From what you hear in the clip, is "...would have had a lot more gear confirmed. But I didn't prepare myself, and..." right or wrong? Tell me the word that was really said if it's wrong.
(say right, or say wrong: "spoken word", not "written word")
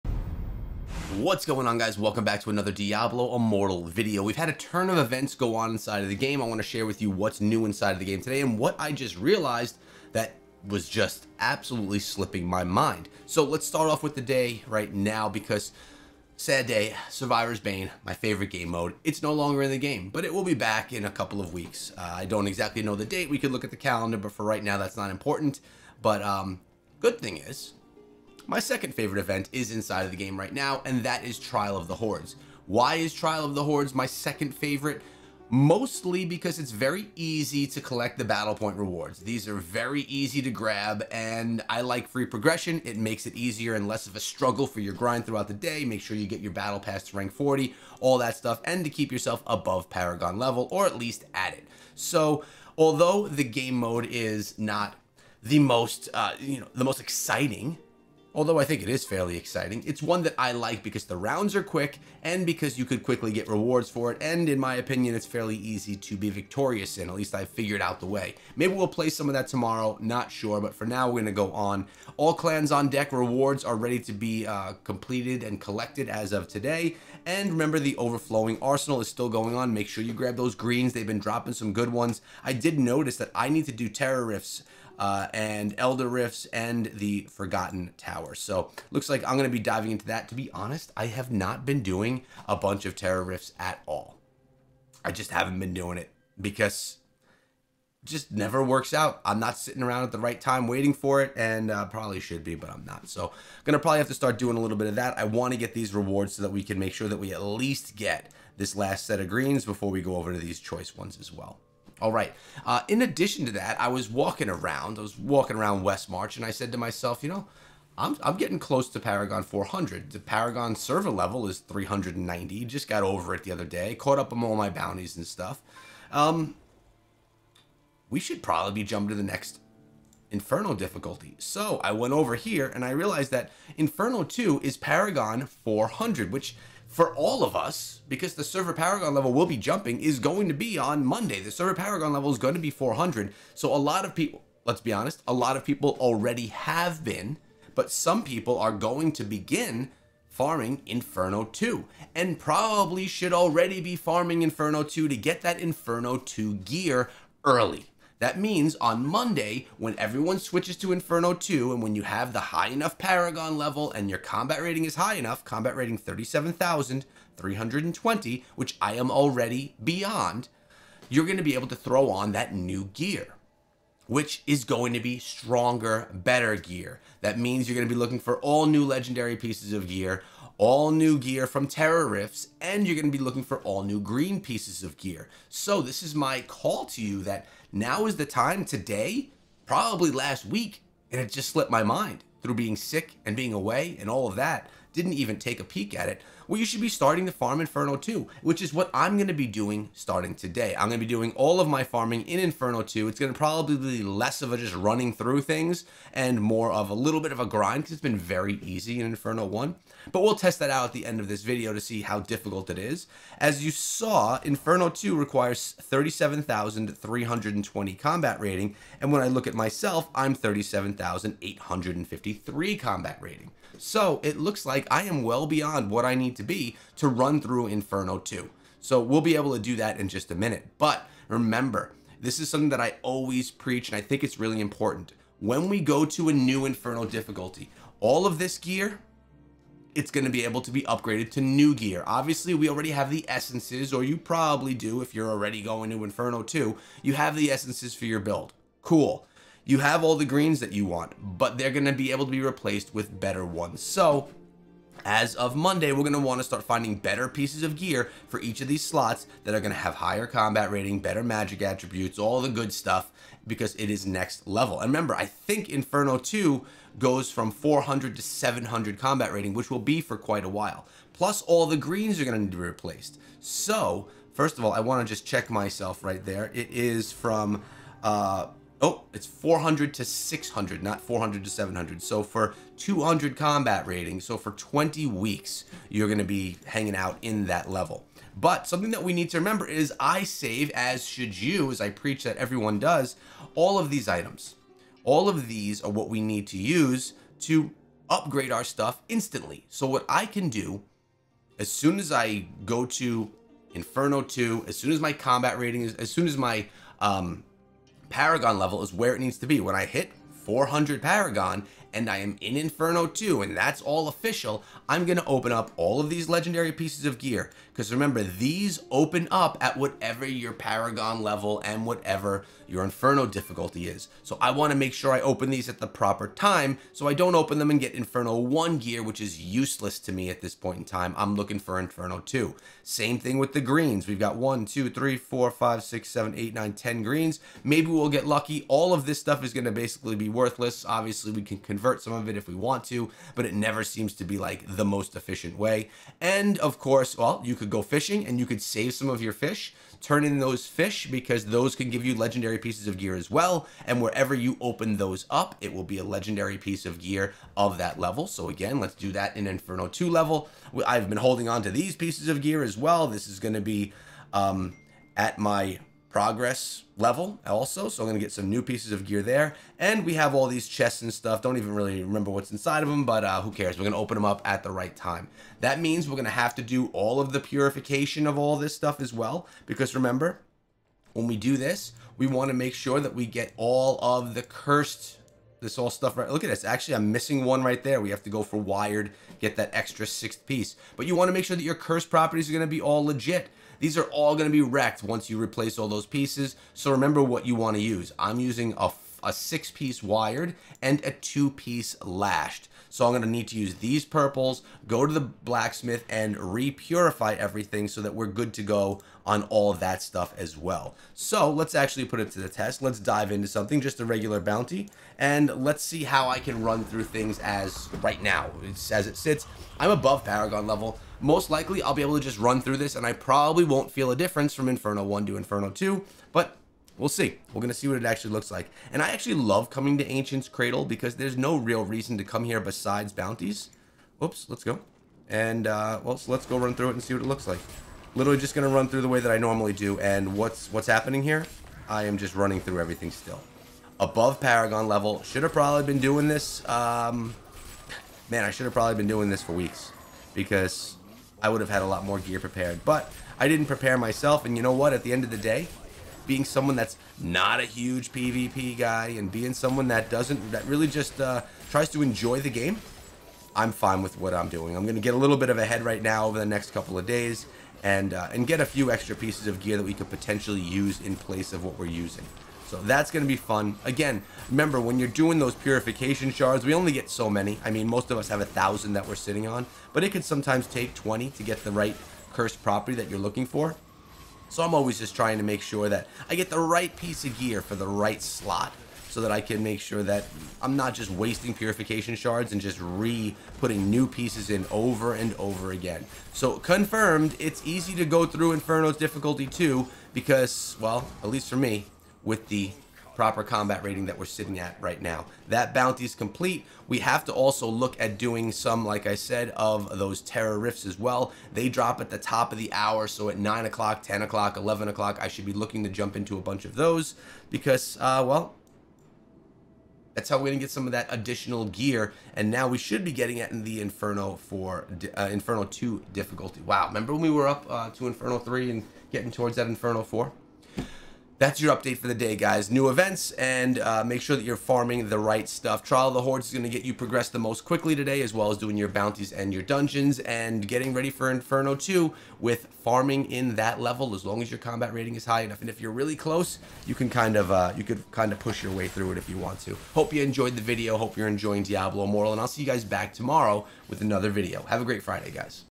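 wrong: "prepared", not "confirmed".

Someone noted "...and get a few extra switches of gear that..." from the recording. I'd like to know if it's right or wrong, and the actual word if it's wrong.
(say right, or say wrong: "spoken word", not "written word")
wrong: "pieces", not "switches".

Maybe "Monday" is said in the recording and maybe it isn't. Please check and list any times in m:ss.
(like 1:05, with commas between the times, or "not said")
2:21, 2:39, 4:15.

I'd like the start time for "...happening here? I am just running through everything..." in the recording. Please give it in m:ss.
7:20.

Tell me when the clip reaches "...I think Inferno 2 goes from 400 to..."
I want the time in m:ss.
4:25.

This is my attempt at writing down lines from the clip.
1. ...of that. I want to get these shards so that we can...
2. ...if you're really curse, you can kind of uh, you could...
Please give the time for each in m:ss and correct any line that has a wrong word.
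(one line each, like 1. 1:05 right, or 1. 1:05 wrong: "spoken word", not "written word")
1. 1:44 wrong: "rewards", not "shards"
2. 9:05 wrong: "close", not "curse".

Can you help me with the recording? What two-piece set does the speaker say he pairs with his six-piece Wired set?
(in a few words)
Lashed.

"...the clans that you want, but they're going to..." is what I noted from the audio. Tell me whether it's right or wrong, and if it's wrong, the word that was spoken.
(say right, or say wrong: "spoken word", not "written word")
wrong: "greens", not "clans".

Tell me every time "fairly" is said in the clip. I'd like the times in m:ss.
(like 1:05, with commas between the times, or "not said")
0:59, 1:05.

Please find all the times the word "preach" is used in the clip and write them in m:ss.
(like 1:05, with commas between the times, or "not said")
3:53, 4:51.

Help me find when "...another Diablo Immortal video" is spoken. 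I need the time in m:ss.
0:02.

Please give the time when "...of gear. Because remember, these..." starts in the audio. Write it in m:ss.
5:17.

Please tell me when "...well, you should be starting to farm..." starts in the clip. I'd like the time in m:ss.
3:16.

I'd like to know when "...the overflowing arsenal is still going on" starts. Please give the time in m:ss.
1:17.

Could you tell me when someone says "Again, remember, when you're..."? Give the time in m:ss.
7:53.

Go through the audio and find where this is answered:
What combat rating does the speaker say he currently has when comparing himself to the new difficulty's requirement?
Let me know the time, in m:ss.
3:40.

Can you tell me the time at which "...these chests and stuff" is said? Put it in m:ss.
6:10.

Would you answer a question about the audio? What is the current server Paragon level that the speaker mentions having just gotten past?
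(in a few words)
390.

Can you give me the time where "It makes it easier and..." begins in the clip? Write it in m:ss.
0:42.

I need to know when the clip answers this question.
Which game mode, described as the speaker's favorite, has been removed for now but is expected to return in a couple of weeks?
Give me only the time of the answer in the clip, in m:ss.
0:17.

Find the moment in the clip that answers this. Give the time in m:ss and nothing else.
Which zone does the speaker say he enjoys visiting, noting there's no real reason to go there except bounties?
7:10.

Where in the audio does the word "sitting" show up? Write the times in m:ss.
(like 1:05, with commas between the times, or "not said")
1:39, 7:59, 8:24.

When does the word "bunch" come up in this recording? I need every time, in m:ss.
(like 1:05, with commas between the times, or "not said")
1:32, 8:36.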